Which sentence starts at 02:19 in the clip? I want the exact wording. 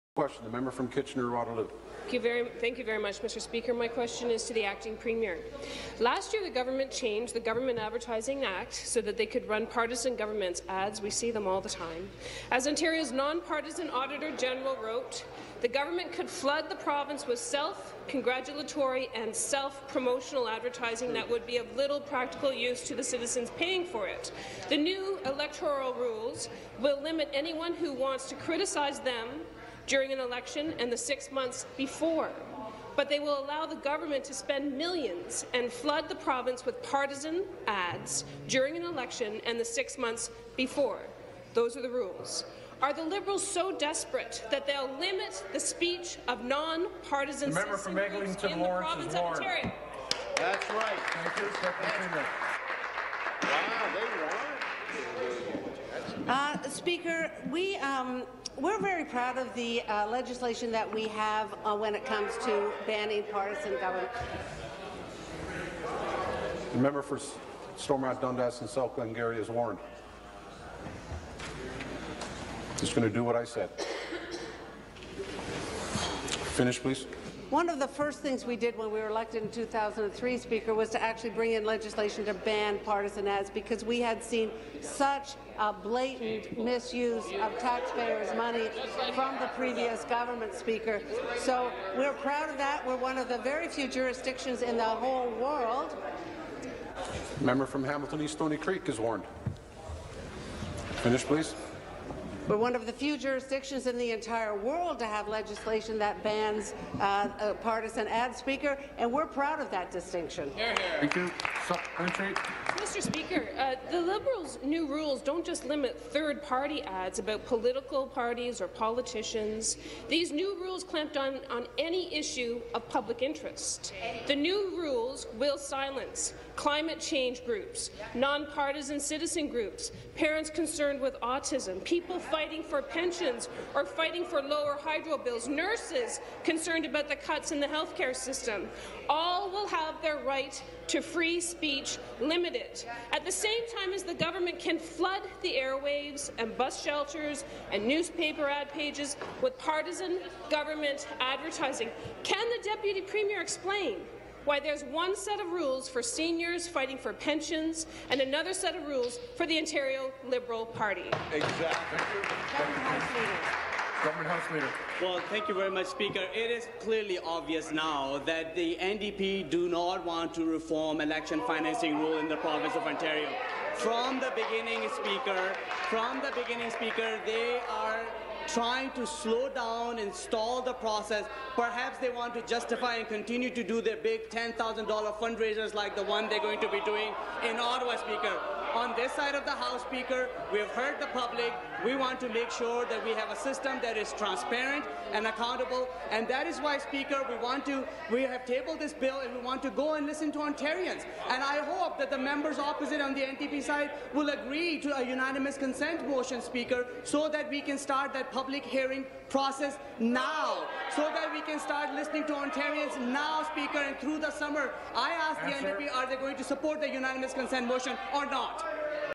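All will have their right to free speech limited.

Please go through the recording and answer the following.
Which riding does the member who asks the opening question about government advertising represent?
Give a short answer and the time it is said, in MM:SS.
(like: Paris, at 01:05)
Kitchener-Waterloo, at 00:00.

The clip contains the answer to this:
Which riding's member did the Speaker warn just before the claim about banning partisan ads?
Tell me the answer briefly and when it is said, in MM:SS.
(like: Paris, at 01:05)
Hamilton East Stoney Creek, at 01:37.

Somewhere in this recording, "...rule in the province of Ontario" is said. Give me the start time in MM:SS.
02:51.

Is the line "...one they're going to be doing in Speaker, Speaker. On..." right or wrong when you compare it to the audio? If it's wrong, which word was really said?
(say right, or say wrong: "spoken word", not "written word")
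wrong: "Ottawa", not "Speaker".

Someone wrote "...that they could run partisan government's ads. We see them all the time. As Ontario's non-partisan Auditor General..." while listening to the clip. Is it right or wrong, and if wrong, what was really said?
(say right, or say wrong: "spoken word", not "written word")
right.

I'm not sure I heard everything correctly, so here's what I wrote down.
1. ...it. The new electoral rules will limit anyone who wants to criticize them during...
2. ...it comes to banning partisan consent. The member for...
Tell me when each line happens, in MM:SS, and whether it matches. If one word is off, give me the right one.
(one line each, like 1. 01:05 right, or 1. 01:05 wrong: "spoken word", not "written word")
1. 00:24 right
2. 01:01 wrong: "government", not "consent".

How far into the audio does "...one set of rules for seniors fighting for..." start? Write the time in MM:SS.
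02:34.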